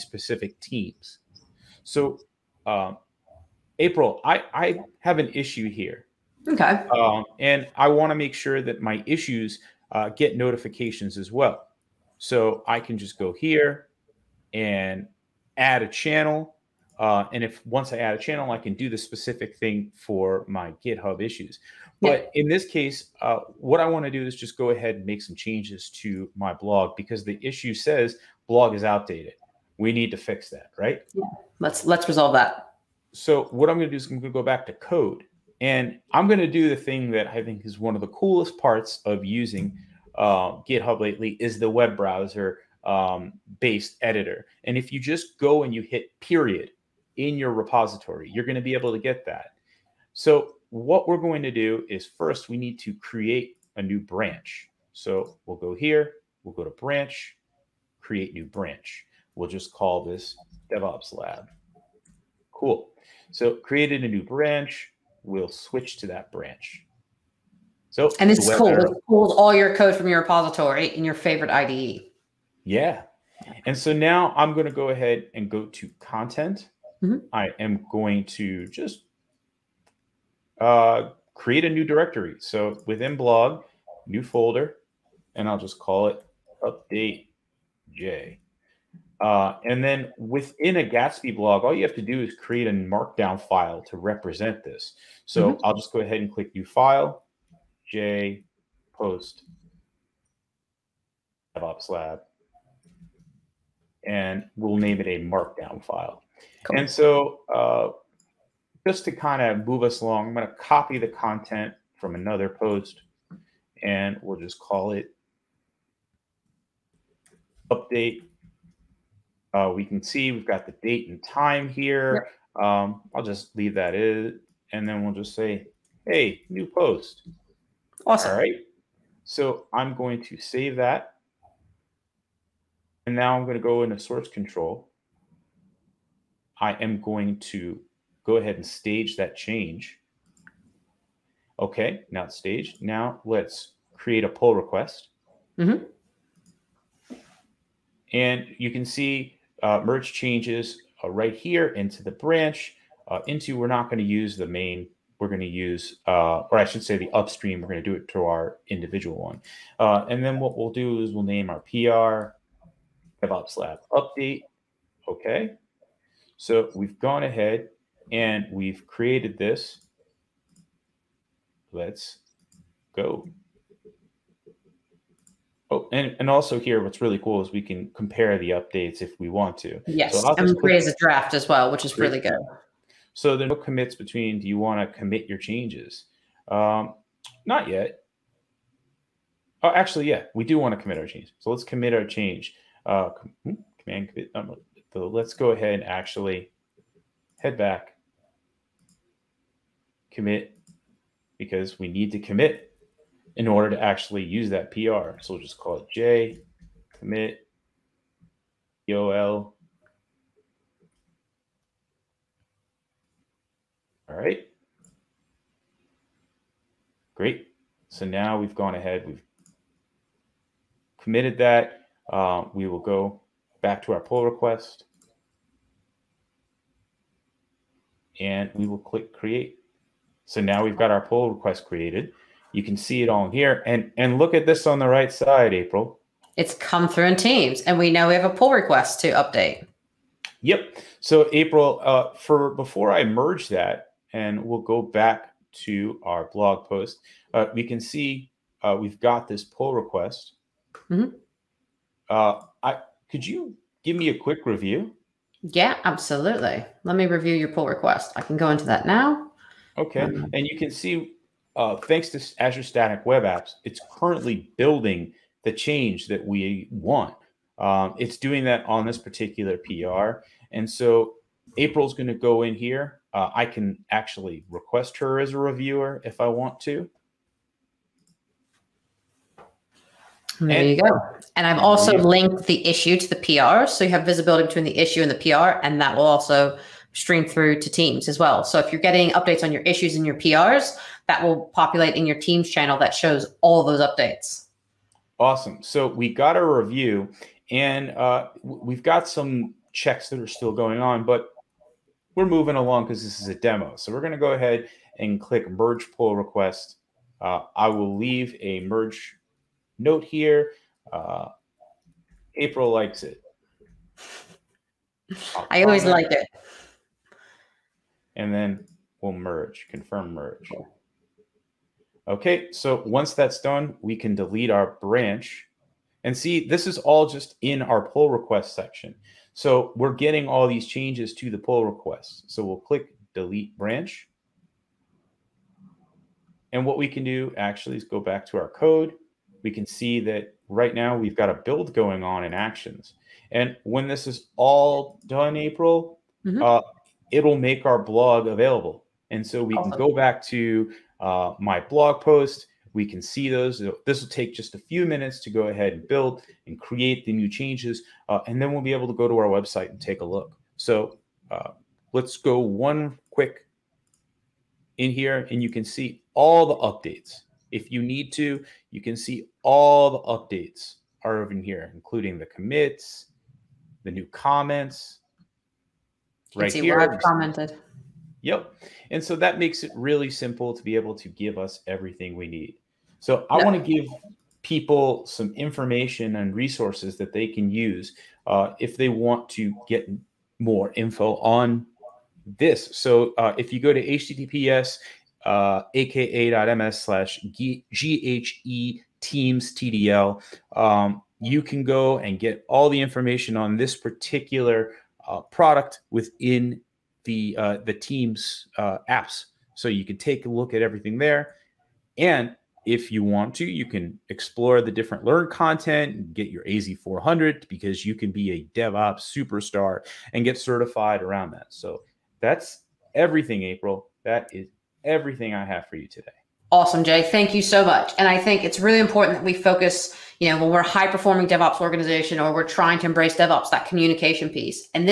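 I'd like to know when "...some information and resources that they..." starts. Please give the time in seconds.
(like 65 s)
385 s.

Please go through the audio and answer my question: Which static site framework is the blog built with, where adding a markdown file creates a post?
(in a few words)
Gatsby.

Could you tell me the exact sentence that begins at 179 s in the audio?
Yes, so and create a draft as well, which is really good.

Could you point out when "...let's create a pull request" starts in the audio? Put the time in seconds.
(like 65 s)
143 s.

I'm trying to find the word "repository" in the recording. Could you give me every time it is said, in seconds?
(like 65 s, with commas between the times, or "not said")
47 s, 70 s.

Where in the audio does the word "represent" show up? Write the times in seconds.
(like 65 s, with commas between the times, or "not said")
93 s.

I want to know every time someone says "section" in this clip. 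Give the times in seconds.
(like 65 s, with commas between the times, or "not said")
328 s.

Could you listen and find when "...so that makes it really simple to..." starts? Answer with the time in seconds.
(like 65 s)
379 s.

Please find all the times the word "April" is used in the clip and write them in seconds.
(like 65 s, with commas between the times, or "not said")
3 s, 235 s, 241 s, 271 s, 312 s, 345 s, 423 s.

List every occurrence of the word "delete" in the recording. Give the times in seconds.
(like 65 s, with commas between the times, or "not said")
324 s, 333 s.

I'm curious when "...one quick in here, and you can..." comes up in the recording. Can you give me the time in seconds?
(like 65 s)
362 s.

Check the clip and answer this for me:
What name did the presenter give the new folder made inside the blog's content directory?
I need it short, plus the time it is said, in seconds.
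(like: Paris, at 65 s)
update J, at 86 s.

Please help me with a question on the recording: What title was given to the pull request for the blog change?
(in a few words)
DevOps Lab update.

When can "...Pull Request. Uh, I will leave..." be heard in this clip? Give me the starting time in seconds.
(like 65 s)
305 s.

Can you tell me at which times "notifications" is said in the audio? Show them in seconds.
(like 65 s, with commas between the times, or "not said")
10 s.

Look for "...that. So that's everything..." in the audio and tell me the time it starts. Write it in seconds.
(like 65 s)
421 s.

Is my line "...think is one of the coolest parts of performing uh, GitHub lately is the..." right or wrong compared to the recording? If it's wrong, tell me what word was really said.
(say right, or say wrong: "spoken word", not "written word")
wrong: "using", not "performing".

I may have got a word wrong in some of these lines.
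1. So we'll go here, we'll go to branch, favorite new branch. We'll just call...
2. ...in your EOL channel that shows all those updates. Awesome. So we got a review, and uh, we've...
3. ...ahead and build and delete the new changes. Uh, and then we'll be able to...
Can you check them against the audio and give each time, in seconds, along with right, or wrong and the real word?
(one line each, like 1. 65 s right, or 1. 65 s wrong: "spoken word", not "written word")
1. 54 s wrong: "create", not "favorite"
2. 291 s wrong: "Teams", not "EOL"
3. 355 s wrong: "create", not "delete".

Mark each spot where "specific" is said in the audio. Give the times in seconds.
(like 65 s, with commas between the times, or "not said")
0 s, 18 s.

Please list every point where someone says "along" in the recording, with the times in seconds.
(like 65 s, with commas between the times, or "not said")
110 s, 302 s.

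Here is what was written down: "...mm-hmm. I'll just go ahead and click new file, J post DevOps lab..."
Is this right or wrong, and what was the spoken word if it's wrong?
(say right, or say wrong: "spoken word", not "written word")
right.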